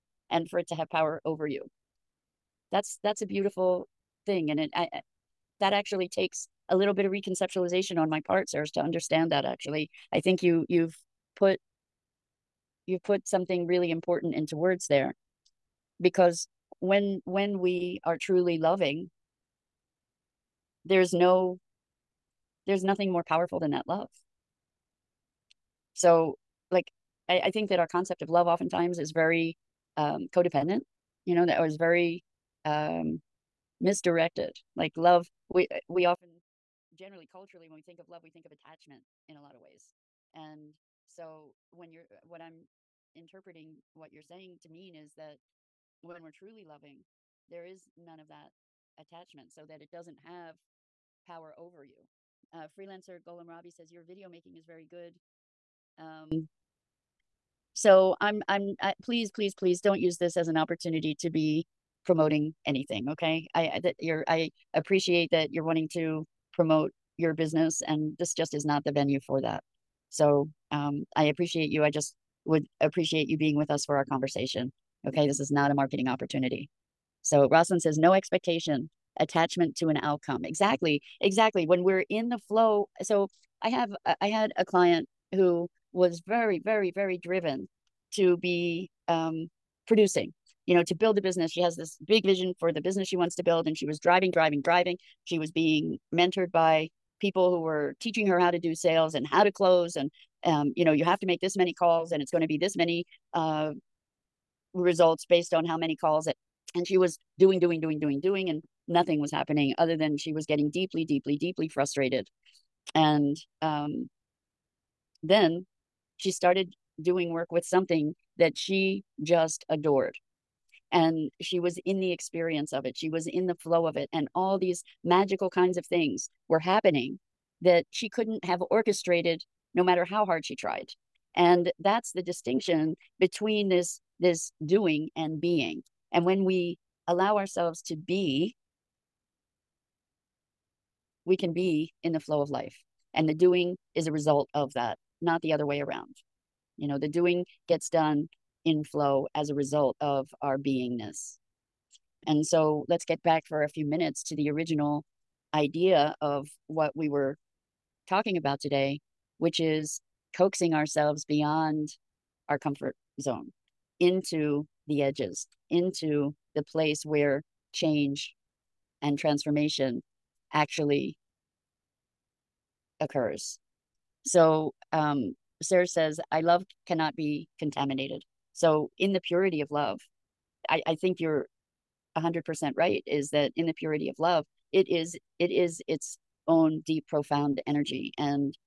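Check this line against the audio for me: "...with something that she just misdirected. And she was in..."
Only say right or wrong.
wrong.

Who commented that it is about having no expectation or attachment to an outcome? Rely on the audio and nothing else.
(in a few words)
Rosalind.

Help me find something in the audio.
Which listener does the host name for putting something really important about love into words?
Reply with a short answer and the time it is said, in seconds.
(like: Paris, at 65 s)
Serge, at 8 s.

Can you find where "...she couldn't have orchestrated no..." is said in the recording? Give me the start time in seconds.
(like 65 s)
127 s.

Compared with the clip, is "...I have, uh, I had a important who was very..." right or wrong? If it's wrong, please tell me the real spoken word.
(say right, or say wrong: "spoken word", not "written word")
wrong: "client", not "important".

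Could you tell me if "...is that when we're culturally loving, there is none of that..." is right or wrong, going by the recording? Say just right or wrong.
wrong.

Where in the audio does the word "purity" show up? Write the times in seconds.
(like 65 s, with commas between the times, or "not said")
179 s, 183 s.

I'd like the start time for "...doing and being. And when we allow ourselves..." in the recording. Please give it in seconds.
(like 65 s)
134 s.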